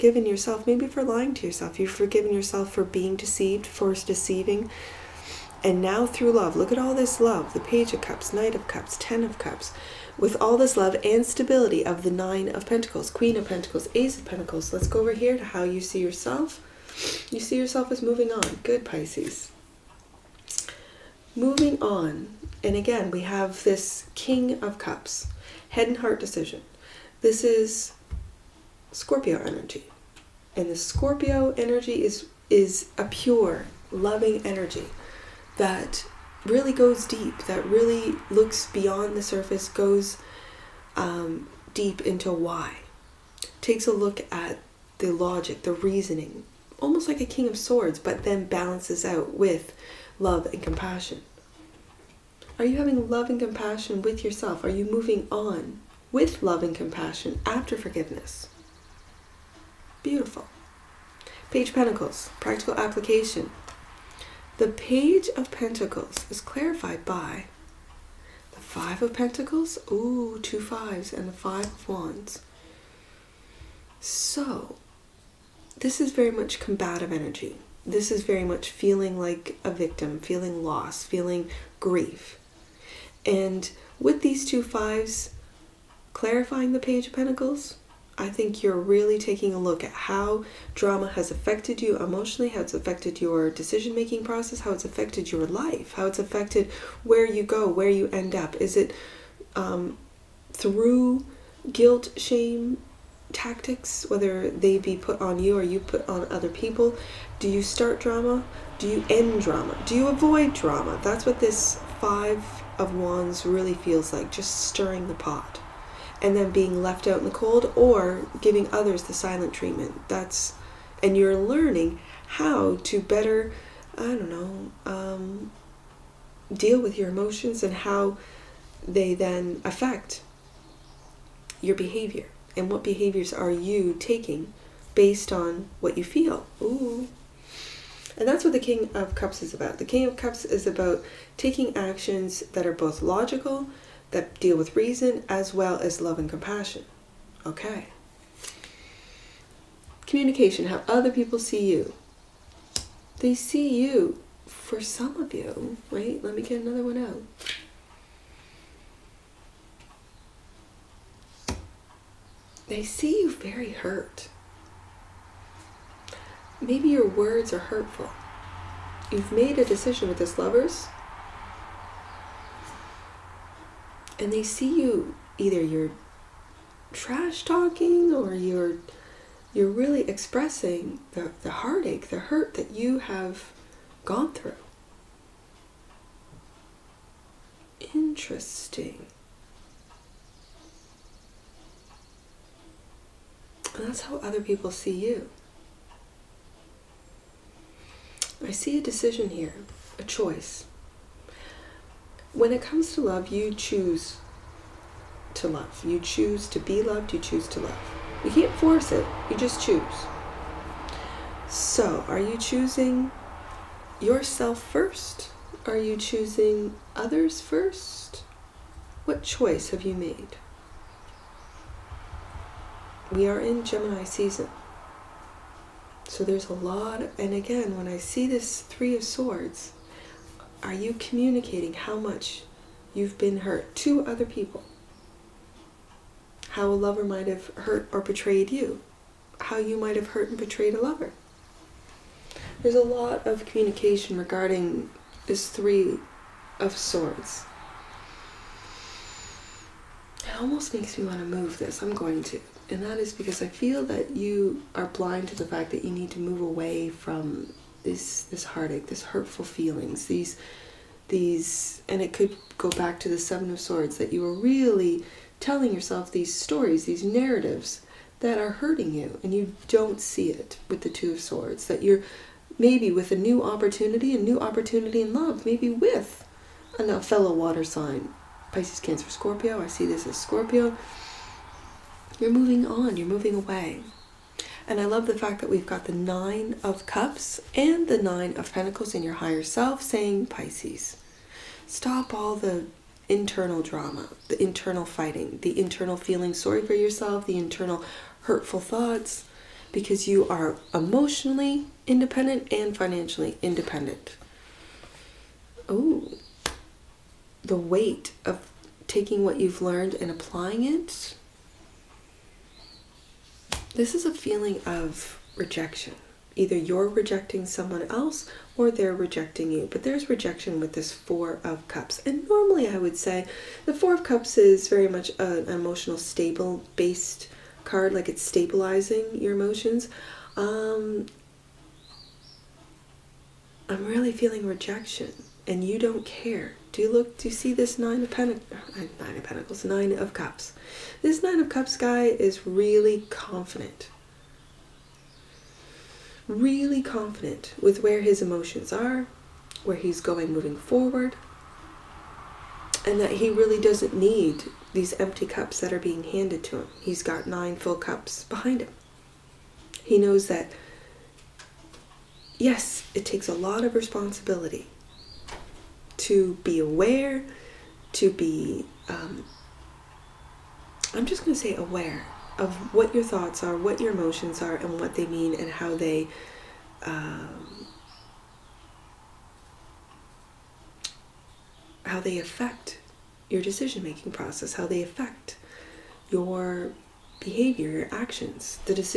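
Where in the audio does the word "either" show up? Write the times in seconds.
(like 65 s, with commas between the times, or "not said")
175 s, 316 s.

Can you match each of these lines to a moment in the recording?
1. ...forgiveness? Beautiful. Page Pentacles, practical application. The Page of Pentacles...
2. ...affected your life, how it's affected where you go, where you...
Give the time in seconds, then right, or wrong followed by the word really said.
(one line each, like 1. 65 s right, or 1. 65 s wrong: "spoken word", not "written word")
1. 57 s right
2. 94 s right.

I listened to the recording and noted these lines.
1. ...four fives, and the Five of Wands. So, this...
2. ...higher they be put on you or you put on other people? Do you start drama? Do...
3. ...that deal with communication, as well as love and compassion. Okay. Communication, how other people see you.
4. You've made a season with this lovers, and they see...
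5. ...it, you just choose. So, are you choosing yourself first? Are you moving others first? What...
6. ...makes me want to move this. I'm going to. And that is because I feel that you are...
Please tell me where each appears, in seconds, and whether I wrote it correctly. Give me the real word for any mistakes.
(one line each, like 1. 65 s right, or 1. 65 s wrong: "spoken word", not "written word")
1. 70 s wrong: "two", not "four"
2. 104 s wrong: "whether", not "higher"
3. 144 s wrong: "reason", not "communication"
4. 169 s wrong: "decision", not "season"
5. 208 s wrong: "choosing", not "moving"
6. 250 s right.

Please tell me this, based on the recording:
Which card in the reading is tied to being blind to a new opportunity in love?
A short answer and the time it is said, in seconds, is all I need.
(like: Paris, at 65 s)
Two of Swords, at 270 s.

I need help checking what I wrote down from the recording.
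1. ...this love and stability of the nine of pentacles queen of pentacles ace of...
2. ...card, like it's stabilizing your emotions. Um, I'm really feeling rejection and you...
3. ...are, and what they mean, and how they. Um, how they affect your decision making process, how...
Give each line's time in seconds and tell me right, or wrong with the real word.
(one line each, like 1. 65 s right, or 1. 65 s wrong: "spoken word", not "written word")
1. 10 s right
2. 327 s right
3. 374 s right.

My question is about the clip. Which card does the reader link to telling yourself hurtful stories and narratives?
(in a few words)
Seven of Swords.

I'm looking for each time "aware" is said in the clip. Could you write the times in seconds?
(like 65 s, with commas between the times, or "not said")
366 s, 371 s.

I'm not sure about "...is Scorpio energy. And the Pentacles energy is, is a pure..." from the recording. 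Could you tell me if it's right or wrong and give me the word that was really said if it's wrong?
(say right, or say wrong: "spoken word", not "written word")
wrong: "Scorpio", not "Pentacles".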